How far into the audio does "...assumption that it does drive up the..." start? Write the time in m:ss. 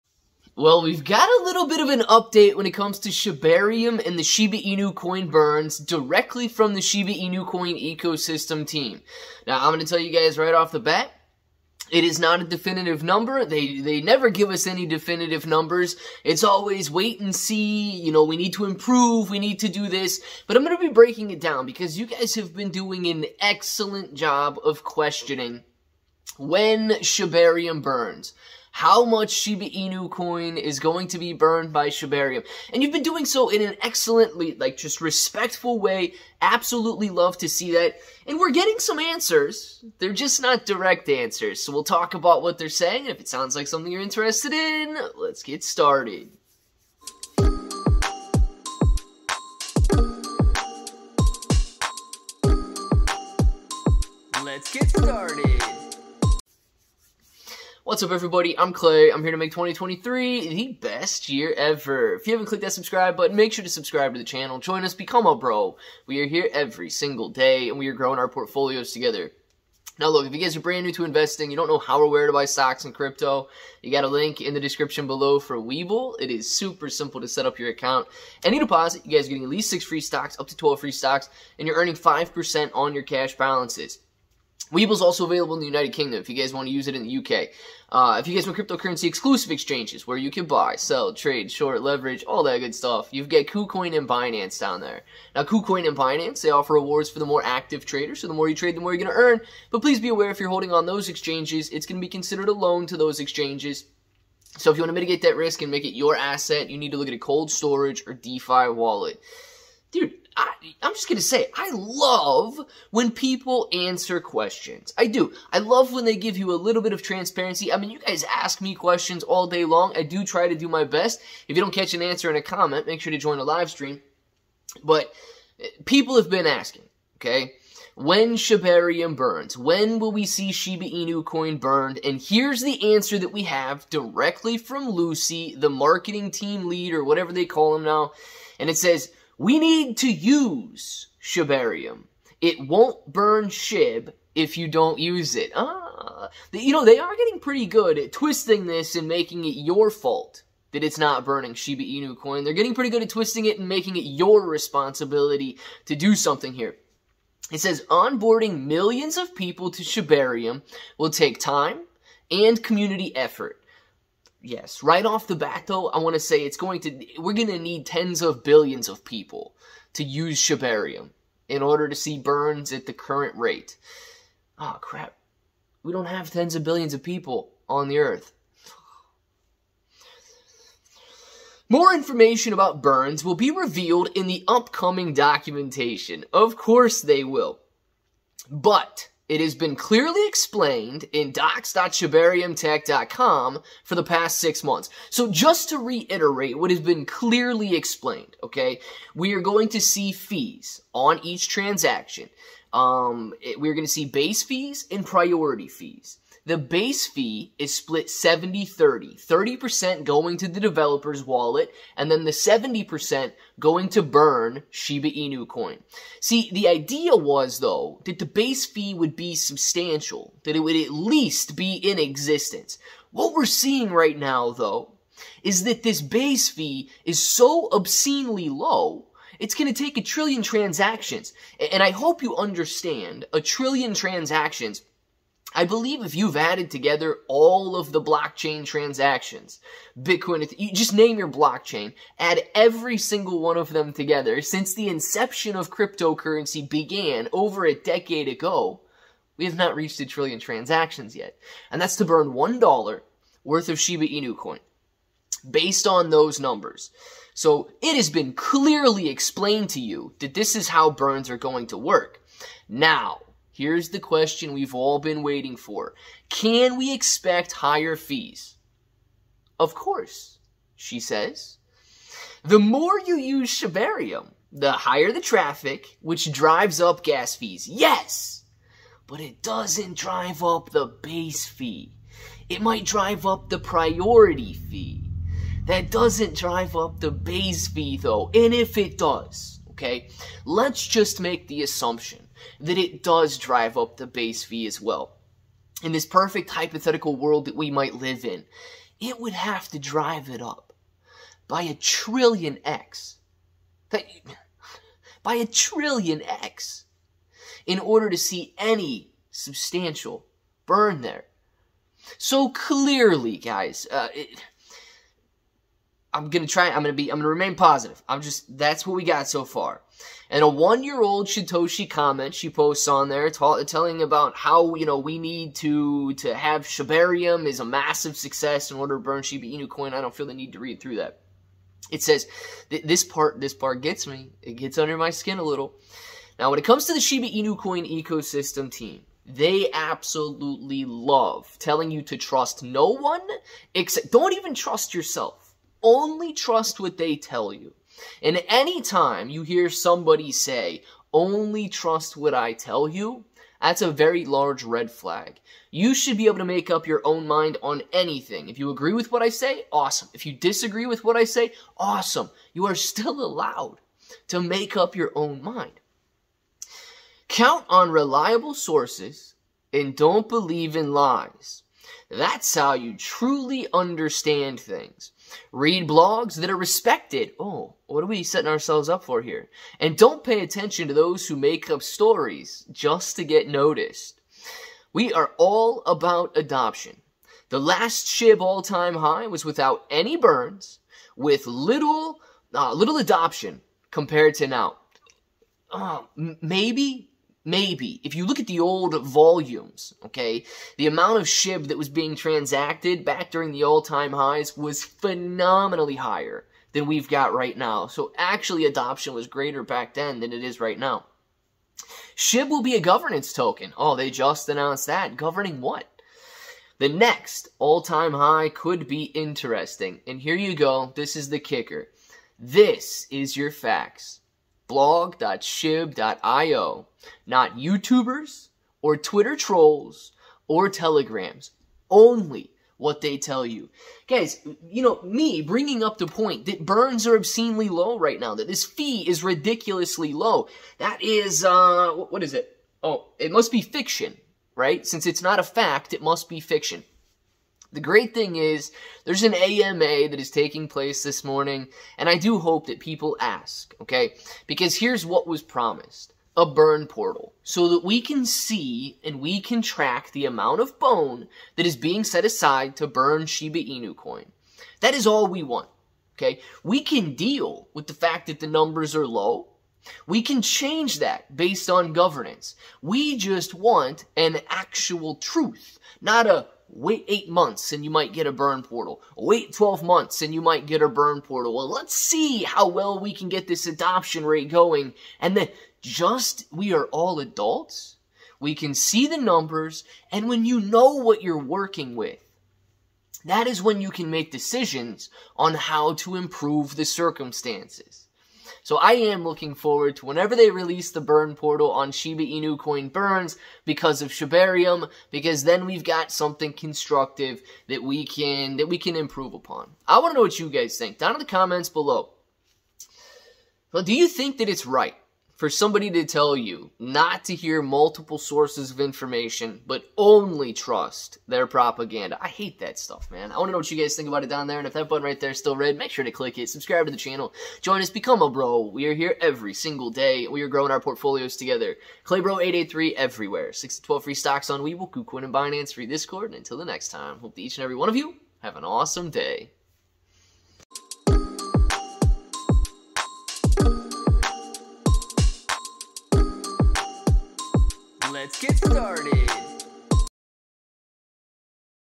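4:51.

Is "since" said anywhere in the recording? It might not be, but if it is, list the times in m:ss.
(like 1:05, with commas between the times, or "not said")
4:04, 7:24.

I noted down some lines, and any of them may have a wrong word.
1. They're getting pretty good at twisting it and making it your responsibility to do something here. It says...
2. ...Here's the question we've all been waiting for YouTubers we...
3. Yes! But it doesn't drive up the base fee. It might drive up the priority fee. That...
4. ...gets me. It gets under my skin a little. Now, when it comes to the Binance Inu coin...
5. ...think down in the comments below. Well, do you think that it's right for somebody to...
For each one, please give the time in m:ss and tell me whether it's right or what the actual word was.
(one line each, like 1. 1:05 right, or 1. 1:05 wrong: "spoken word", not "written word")
1. 2:32 right
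2. 4:23 wrong: "Can", not "YouTubers"
3. 4:37 right
4. 5:33 wrong: "Shiba", not "Binance"
5. 8:30 right.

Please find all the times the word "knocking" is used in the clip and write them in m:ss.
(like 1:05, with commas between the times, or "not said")
not said.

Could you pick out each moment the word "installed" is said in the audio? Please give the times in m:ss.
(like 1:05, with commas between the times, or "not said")
not said.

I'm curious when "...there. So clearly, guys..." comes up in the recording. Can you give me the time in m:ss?
5:11.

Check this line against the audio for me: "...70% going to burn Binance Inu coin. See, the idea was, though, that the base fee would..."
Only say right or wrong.
wrong.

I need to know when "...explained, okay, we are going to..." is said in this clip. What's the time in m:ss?
3:17.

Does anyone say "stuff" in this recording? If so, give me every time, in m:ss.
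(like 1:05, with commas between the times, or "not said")
1:32, 8:42.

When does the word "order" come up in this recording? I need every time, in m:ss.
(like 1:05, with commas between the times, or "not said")
2:51, 5:07, 5:28.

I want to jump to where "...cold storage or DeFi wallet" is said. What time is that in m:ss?
1:47.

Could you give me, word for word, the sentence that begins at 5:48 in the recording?
And anytime you hear somebody say, only trust what I tell you, that's a very large red flag.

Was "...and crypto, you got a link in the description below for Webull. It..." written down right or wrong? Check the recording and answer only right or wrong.
right.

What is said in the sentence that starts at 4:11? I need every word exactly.
And that's to burn $1 worth of Shiba Inu coin based on those numbers.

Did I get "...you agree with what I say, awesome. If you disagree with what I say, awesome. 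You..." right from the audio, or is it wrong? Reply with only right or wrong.
right.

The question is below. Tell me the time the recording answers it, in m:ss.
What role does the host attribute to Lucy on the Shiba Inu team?
2:15.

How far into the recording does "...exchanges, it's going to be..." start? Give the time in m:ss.
1:41.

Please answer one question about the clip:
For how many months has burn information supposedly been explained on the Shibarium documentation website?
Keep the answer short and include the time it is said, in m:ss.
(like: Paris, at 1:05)
6, at 3:14.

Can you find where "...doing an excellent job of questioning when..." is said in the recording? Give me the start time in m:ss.
0:22.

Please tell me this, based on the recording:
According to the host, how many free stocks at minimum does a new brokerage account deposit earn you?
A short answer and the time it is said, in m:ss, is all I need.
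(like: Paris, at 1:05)
6, at 1:19.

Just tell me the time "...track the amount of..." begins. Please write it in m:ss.
7:39.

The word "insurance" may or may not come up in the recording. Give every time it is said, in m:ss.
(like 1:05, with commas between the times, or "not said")
not said.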